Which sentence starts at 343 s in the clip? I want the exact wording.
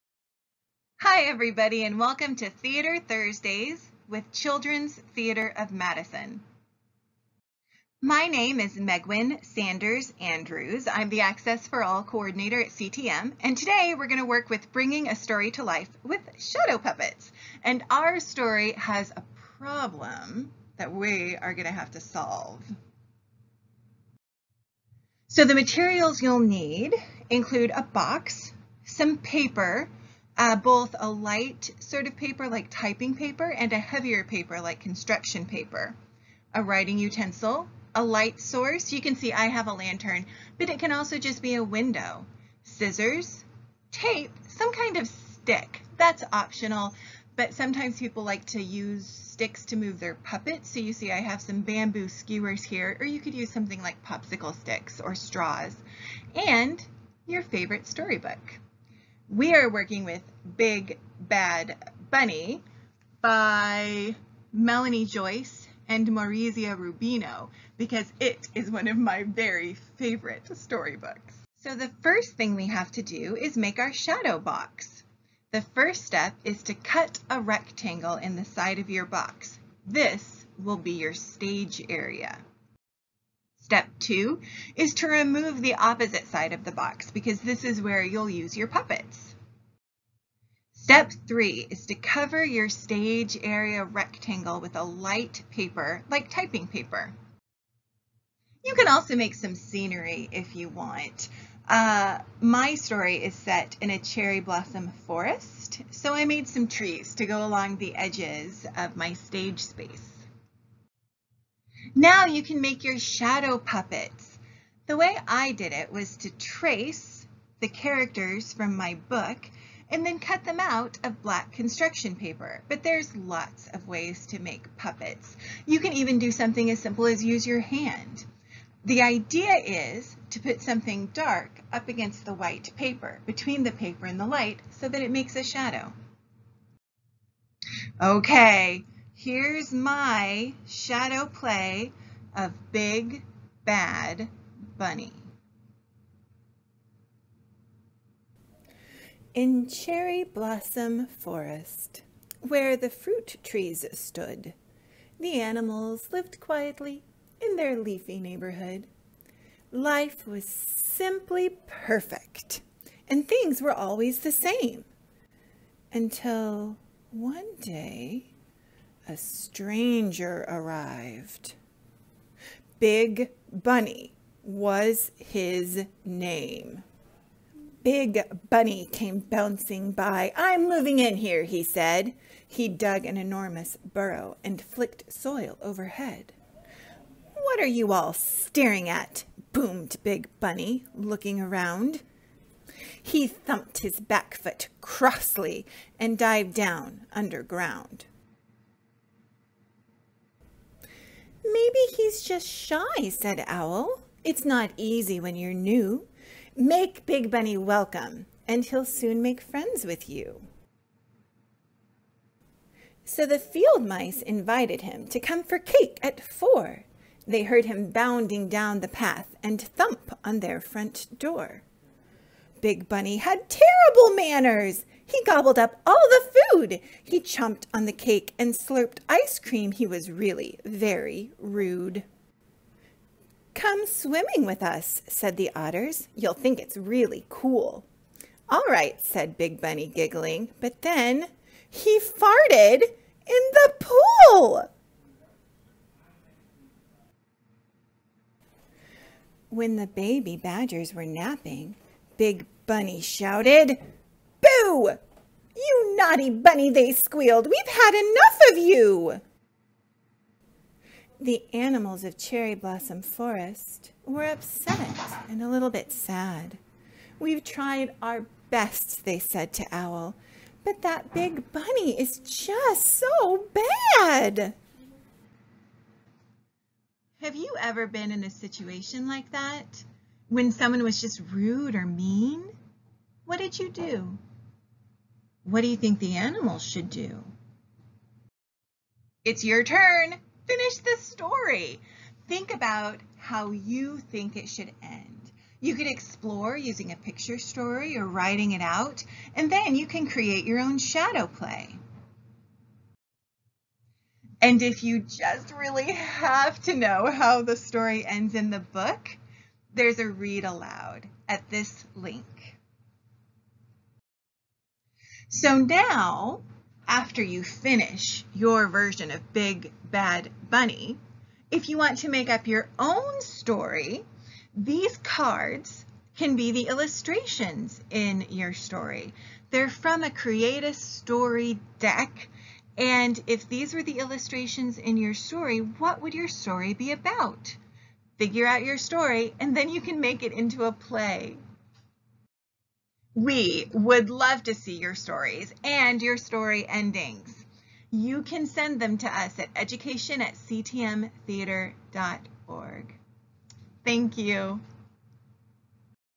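We would love to see your stories and your story endings.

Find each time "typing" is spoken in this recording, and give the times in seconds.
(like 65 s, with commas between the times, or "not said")
32 s, 96 s.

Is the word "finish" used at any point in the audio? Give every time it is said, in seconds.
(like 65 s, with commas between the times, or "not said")
290 s, 317 s.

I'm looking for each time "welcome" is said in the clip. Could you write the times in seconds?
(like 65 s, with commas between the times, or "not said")
1 s, 207 s.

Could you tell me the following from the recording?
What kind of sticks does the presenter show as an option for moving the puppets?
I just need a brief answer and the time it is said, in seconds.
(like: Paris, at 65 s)
bamboo skewers, at 51 s.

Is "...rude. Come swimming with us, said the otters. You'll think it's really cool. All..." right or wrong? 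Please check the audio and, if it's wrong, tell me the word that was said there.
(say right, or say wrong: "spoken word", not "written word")
right.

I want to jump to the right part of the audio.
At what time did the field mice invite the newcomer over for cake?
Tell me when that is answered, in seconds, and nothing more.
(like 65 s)
216 s.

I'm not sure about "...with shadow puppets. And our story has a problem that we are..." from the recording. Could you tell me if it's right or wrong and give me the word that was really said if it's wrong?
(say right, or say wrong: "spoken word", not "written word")
right.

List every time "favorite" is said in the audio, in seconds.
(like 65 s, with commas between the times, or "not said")
57 s, 69 s.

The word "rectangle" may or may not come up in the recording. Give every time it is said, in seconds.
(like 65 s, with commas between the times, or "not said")
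77 s, 93 s.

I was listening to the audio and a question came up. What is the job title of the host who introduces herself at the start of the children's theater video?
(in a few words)
Access for All coordinator.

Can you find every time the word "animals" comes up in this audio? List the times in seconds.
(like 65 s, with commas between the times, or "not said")
155 s, 261 s, 286 s.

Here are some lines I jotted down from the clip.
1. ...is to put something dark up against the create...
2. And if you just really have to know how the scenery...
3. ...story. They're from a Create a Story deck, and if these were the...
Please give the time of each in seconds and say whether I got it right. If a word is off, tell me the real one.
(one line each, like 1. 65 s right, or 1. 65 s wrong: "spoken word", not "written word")
1. 129 s wrong: "white", not "create"
2. 304 s wrong: "story", not "scenery"
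3. 328 s right.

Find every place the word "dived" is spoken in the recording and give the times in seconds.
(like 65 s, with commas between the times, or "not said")
196 s.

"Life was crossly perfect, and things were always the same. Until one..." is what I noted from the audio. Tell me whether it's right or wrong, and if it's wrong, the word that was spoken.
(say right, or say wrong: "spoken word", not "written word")
wrong: "simply", not "crossly".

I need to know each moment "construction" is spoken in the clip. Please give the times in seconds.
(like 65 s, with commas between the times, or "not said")
34 s, 121 s.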